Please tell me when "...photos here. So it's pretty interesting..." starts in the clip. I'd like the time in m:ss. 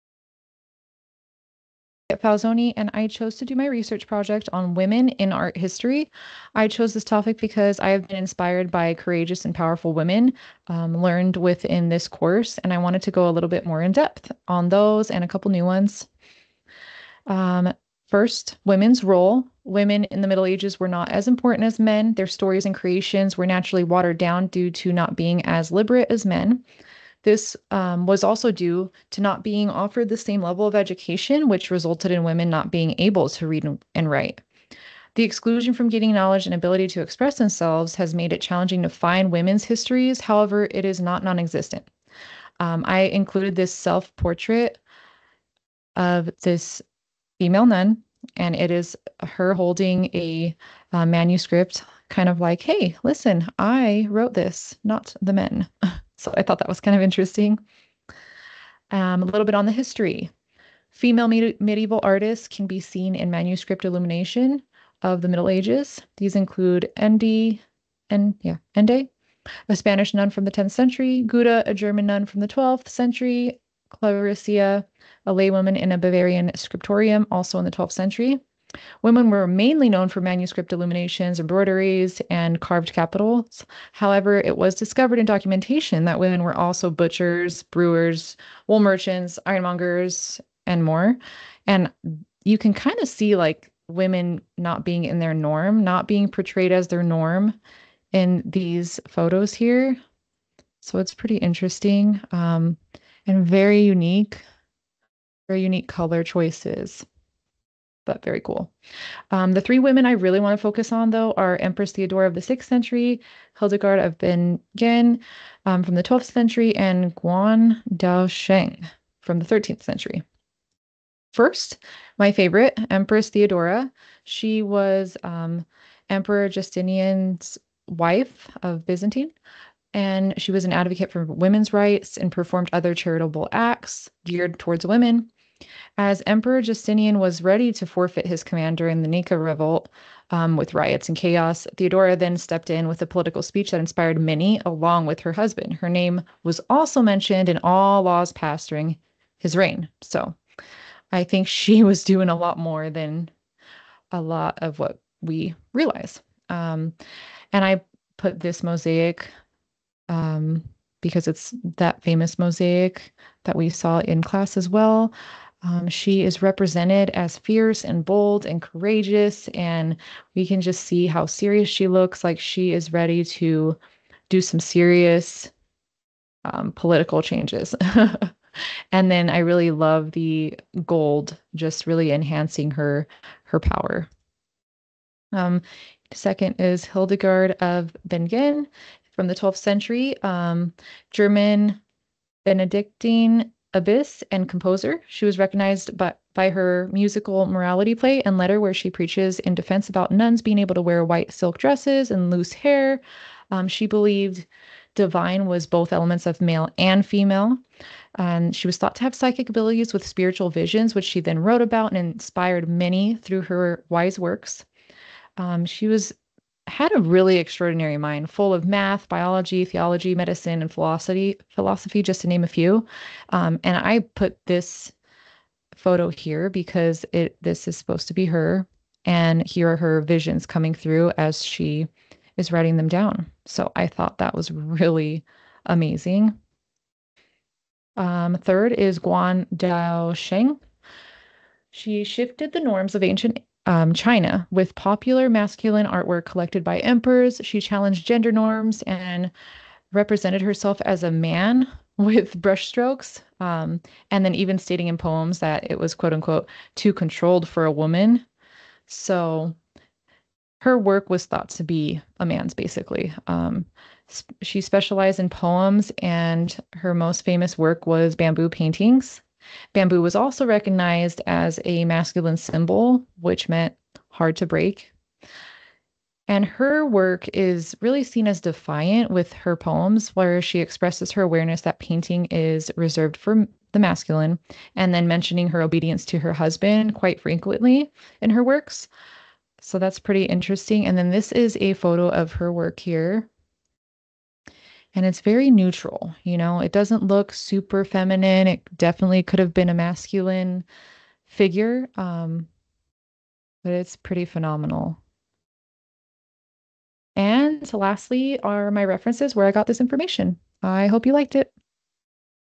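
1:39.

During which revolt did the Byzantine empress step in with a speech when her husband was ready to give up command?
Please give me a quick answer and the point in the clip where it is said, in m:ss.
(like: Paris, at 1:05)
Nika revolt, at 2:19.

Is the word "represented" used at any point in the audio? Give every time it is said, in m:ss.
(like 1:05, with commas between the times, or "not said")
2:46, 4:09.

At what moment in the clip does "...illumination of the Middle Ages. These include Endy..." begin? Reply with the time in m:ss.
1:03.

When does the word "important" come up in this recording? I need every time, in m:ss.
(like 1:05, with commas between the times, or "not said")
0:21.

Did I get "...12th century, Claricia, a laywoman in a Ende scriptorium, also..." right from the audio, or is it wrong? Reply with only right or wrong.
wrong.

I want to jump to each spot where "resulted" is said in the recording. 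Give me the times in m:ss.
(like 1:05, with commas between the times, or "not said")
0:31.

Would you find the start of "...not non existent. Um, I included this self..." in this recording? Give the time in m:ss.
0:41.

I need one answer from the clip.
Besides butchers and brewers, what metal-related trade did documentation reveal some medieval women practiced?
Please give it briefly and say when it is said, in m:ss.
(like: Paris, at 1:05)
Ironmongers, at 1:29.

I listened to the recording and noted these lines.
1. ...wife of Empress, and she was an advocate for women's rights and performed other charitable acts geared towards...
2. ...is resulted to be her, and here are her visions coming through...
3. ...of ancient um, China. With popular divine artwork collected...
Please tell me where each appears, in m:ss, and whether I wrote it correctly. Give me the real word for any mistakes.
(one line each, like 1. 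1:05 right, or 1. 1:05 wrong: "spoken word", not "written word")
1. 2:07 wrong: "Byzantine", not "Empress"
2. 3:47 wrong: "supposed", not "resulted"
3. 4:02 wrong: "masculine", not "divine".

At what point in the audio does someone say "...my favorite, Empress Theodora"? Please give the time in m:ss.
2:02.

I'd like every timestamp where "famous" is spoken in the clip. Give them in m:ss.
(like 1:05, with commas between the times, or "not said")
2:42, 4:27.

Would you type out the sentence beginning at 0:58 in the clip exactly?
Um, a little bit on the history.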